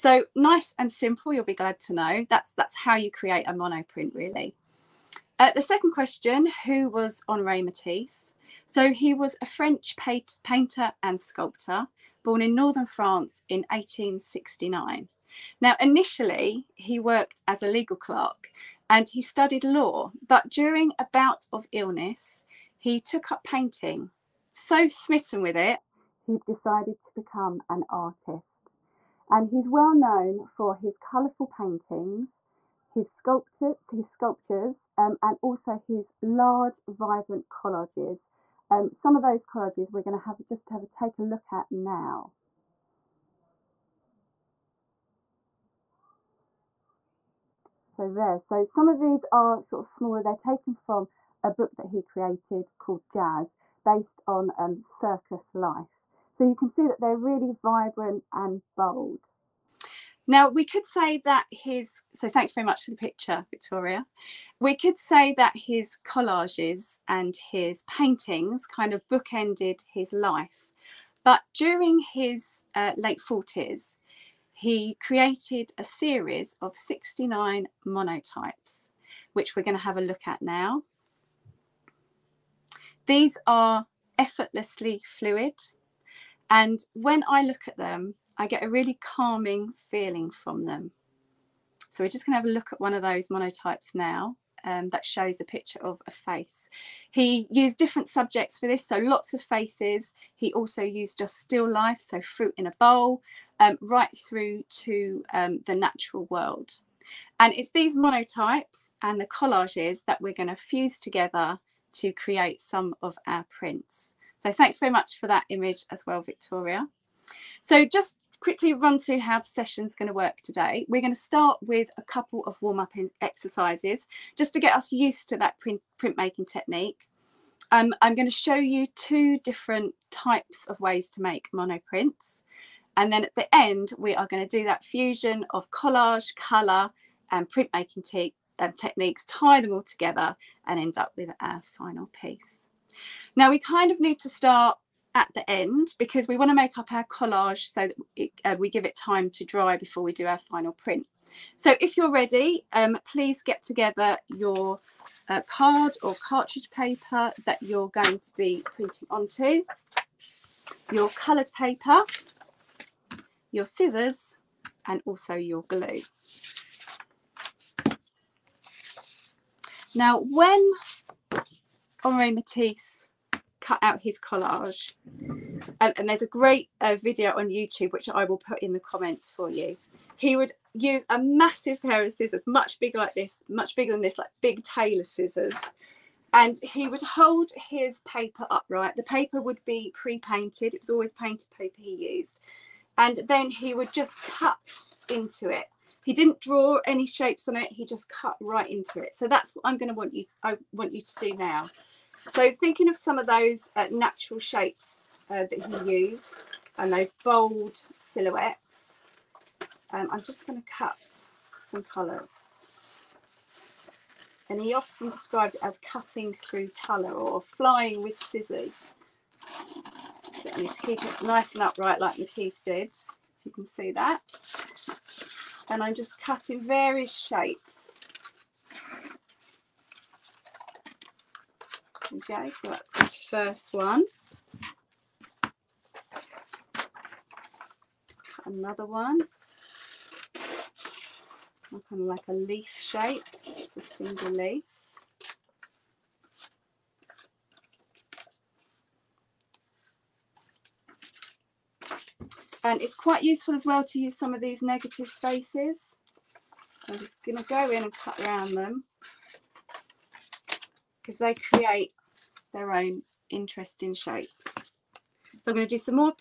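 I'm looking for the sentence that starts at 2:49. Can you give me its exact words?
Now when Henri Matisse cut out his collage.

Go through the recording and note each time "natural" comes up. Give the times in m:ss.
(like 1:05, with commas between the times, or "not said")
1:45, 3:23.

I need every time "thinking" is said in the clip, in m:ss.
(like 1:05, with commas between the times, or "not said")
3:22.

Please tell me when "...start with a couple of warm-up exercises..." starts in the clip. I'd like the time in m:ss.
2:01.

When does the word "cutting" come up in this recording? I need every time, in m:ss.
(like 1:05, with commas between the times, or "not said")
3:35, 3:46.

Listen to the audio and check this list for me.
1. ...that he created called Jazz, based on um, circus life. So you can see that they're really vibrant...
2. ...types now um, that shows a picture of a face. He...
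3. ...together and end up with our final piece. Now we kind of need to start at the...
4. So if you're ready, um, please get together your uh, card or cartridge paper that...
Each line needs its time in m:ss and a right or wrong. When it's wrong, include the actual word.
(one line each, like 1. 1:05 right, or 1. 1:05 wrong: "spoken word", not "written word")
1. 0:51 right
2. 1:33 wrong: "monotypes", not "types"
3. 2:19 right
4. 2:31 right.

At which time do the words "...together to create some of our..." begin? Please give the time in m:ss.
1:50.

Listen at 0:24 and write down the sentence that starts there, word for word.
So smitten with it, he decided to become an artist.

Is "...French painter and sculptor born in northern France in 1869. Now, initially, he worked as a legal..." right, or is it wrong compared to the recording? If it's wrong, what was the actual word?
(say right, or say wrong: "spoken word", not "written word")
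right.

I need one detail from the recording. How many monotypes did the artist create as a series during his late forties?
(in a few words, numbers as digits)
69.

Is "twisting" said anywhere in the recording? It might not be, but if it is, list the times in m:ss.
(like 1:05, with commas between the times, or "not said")
not said.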